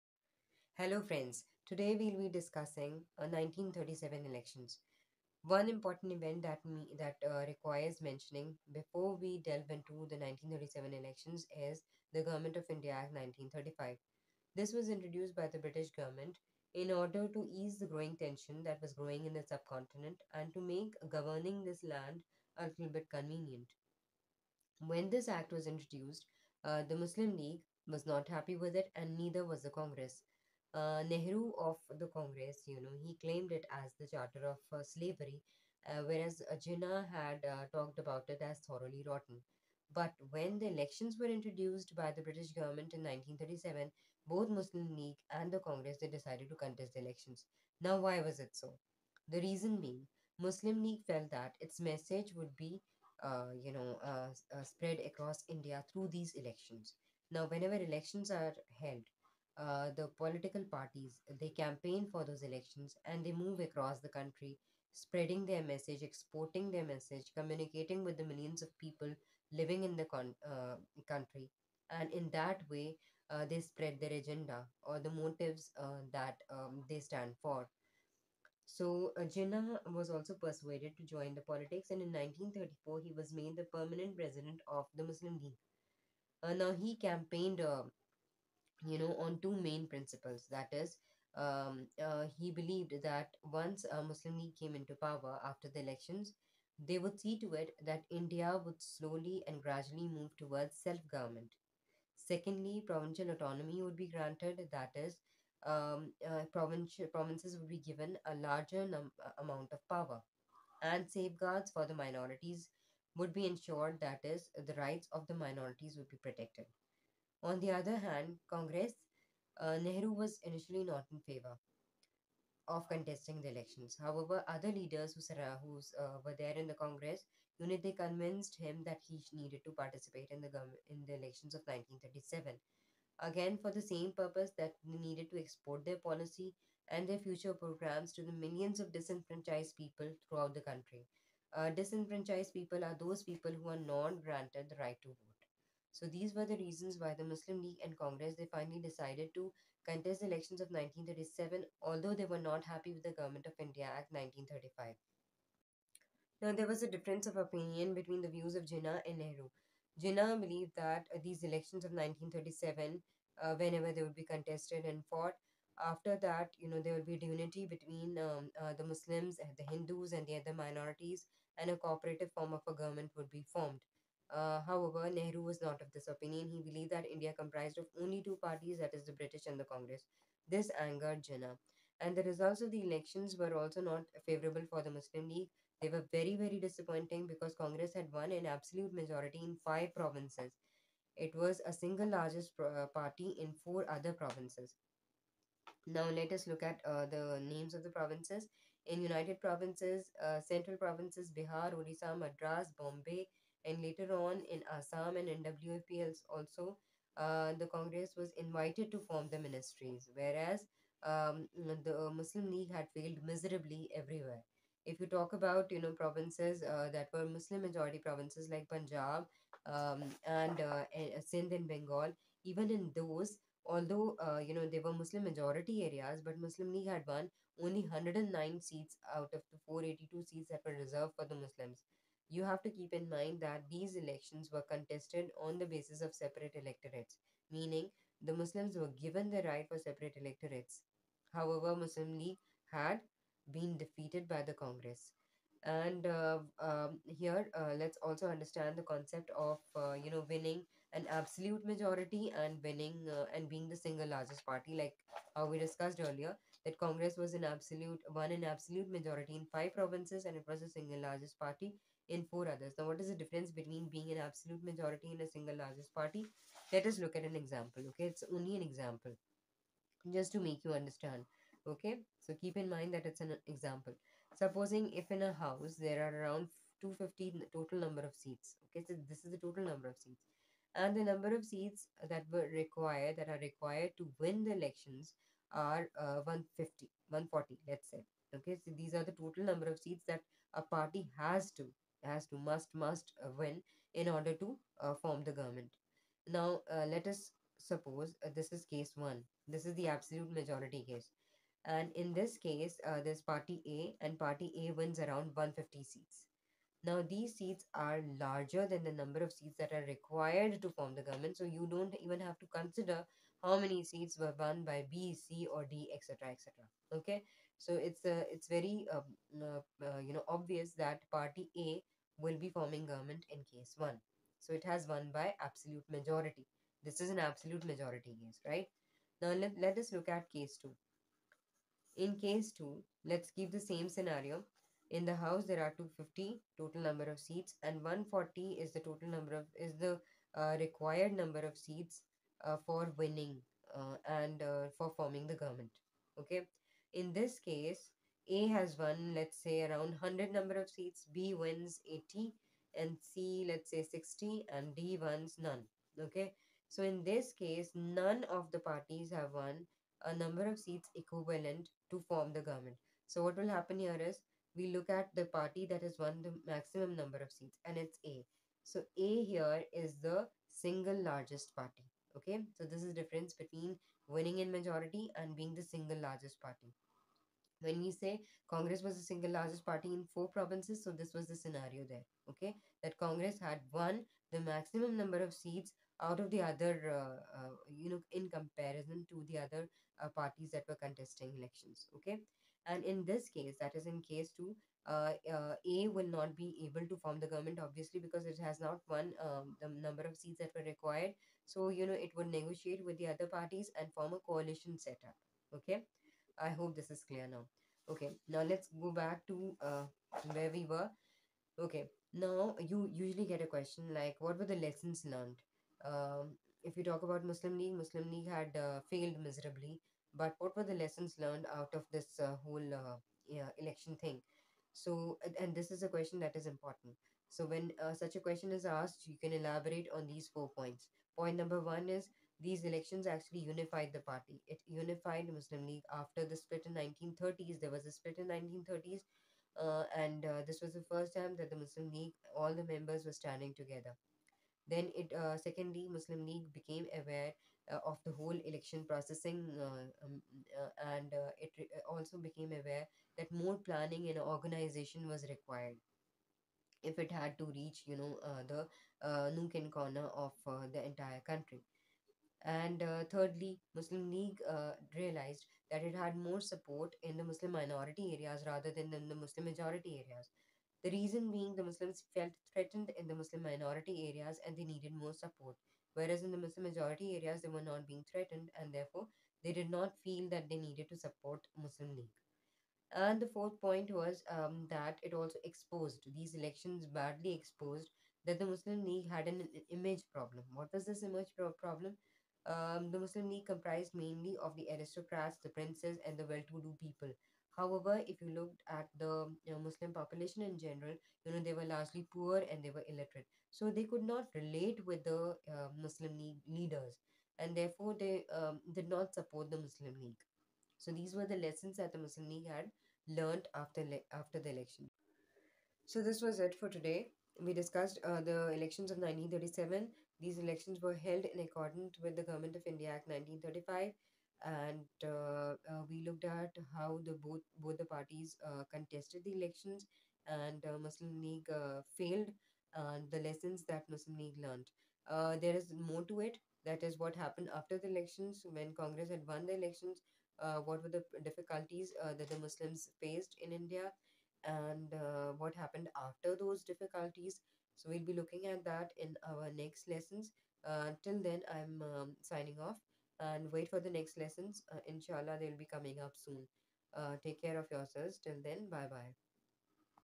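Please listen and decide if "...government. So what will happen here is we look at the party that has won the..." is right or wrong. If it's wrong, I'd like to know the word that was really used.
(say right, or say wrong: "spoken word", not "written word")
right.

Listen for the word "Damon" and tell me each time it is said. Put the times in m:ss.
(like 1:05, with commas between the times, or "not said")
not said.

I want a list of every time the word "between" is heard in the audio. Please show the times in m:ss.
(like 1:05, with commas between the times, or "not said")
2:37, 2:47, 4:23, 6:13.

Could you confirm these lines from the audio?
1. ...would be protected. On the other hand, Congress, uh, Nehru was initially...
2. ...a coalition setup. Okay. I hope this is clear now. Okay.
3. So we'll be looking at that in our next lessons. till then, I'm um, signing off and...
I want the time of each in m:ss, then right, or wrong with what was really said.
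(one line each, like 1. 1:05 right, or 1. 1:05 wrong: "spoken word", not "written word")
1. 1:55 right
2. 6:44 right
3. 9:07 right.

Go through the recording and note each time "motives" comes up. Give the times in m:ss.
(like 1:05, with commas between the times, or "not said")
1:15.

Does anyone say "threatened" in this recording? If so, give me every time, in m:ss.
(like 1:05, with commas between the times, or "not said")
7:52, 7:58.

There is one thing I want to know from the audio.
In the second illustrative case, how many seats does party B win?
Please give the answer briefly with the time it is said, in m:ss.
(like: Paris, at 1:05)
80, at 5:51.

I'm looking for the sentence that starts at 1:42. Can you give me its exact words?
Secondly, provincial autonomy would be granted, that is, um, uh, provincial, provinces would be given a larger num- uh, amount of power.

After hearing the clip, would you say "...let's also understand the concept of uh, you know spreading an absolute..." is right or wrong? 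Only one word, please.
wrong.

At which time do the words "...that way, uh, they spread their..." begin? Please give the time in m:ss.
1:12.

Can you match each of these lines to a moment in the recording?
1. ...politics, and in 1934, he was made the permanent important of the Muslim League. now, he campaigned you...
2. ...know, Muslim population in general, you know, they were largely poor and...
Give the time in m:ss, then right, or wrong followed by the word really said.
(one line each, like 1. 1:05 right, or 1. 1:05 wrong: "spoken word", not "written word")
1. 1:21 wrong: "president", not "important"
2. 8:19 right.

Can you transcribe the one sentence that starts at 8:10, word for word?
What was this image pro- problem?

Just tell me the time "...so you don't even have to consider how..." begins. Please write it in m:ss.
5:11.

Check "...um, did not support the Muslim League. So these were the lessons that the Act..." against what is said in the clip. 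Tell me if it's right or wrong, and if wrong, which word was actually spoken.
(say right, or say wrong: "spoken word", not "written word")
wrong: "Muslim", not "Act".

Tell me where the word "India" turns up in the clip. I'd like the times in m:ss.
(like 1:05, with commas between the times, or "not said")
0:12, 0:55, 1:38, 2:33, 2:57, 8:42, 9:03.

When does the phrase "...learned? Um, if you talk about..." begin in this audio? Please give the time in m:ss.
6:55.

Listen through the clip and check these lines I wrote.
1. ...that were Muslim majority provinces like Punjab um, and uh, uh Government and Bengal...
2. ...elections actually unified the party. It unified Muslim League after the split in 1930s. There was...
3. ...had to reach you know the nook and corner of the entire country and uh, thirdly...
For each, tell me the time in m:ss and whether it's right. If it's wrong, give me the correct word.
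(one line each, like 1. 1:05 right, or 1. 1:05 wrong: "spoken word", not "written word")
1. 3:36 wrong: "Sindh", not "Government"
2. 7:12 right
3. 7:37 right.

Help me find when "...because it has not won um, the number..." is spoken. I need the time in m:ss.
6:37.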